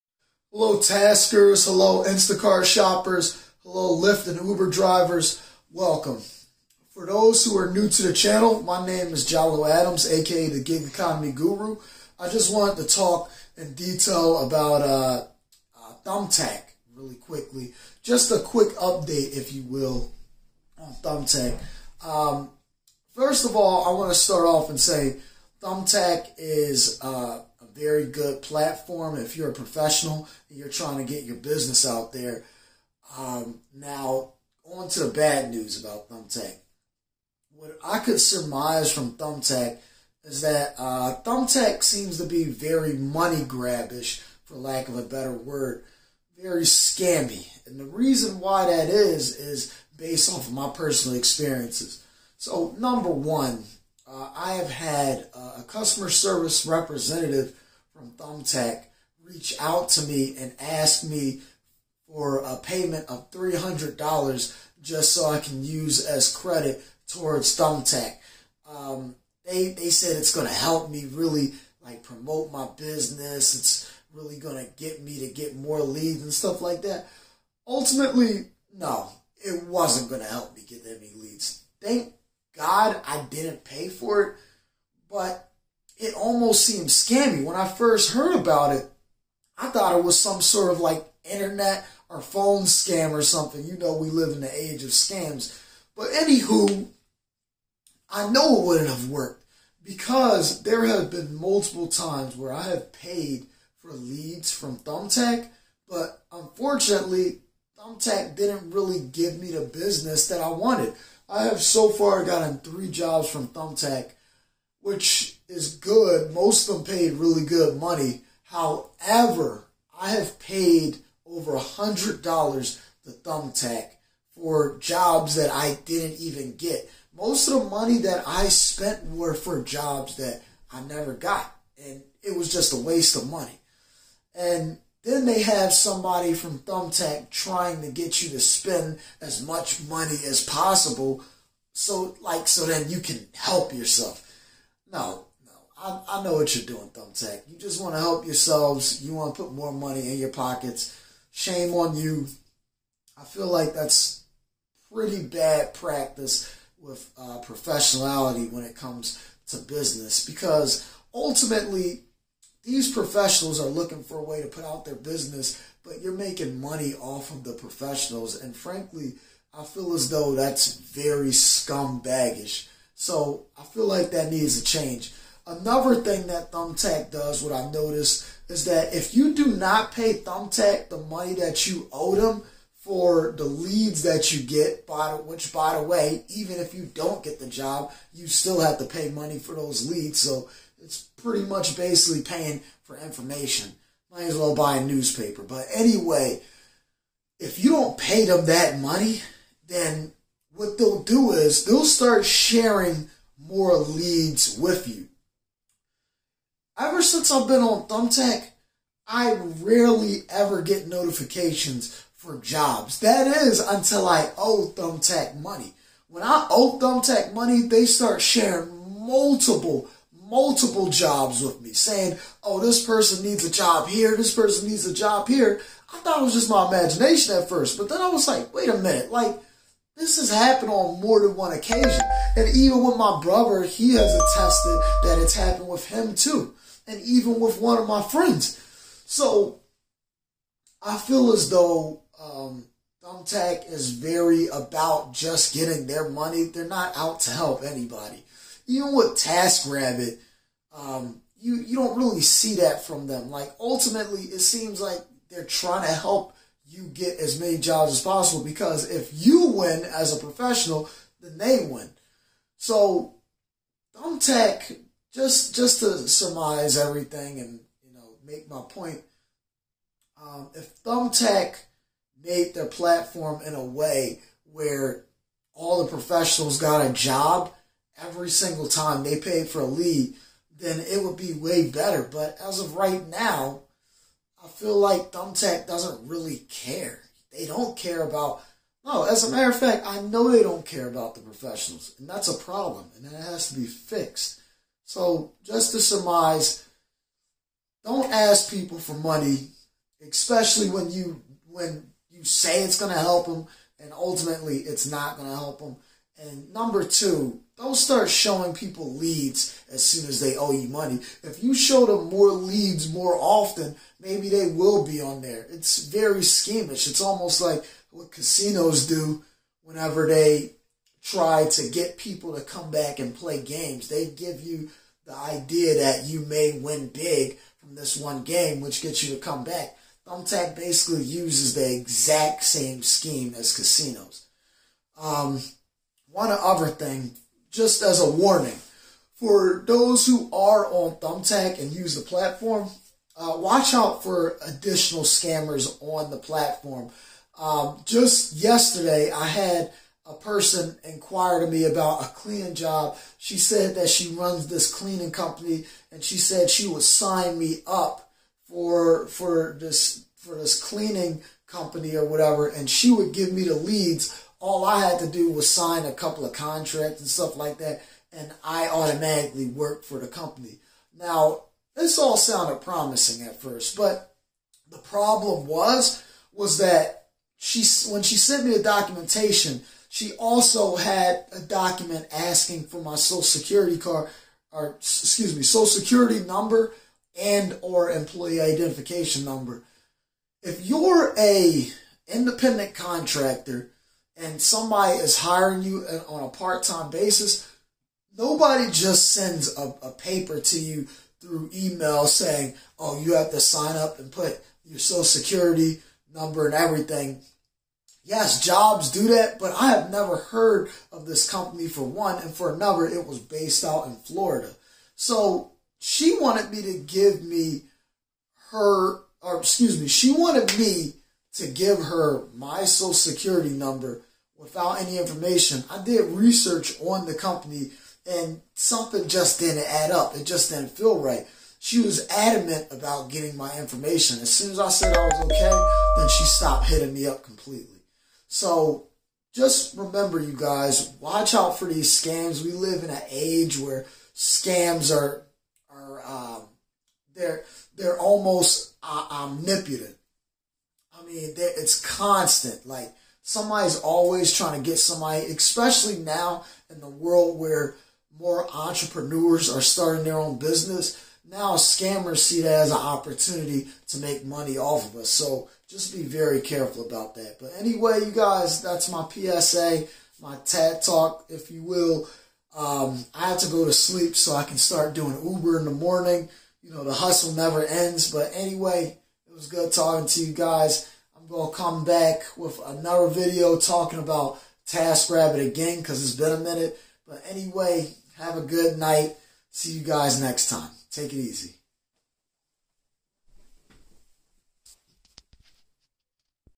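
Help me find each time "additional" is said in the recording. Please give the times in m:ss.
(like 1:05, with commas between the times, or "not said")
5:44.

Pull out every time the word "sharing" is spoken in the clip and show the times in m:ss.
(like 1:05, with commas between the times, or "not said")
3:22, 3:38.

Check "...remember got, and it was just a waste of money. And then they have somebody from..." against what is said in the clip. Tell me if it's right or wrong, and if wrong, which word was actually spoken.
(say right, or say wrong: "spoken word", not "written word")
wrong: "never", not "remember".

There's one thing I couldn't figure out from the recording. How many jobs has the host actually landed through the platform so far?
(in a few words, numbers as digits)
3.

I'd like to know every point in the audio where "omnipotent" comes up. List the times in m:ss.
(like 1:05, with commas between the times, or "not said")
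7:29.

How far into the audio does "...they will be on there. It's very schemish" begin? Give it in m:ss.
5:14.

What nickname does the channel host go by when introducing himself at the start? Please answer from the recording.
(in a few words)
Gig Economy Guru.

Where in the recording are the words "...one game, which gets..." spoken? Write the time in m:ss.
5:27.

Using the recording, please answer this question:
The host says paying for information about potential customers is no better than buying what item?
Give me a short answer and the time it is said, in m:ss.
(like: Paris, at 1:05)
a newspaper, at 3:14.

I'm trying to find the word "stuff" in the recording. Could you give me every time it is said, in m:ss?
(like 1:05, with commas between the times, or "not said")
1:16, 6:07.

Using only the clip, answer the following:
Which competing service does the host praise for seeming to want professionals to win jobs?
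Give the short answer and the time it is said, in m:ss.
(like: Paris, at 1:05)
TaskRabbit, at 4:09.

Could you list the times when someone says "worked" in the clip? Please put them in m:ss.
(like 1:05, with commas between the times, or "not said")
1:39, 6:09.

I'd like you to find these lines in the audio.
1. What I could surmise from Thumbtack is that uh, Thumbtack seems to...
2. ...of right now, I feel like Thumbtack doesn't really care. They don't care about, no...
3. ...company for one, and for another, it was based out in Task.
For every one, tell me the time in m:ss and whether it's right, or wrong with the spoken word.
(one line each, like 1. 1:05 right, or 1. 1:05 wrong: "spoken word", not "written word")
1. 0:37 right
2. 4:42 right
3. 6:51 wrong: "Florida", not "Task".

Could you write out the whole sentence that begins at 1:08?
Um, they, they said it's going to help me really like promote my business.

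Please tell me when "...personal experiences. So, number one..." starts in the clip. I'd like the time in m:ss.
0:50.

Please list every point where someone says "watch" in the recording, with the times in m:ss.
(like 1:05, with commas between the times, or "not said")
5:43, 7:21.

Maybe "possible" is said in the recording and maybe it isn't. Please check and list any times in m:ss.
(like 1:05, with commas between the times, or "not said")
2:20, 4:18.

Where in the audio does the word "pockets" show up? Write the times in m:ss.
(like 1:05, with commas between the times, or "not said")
2:30.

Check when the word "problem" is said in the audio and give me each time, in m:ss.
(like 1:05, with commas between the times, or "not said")
4:52, 6:14.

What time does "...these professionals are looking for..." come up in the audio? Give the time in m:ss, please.
2:42.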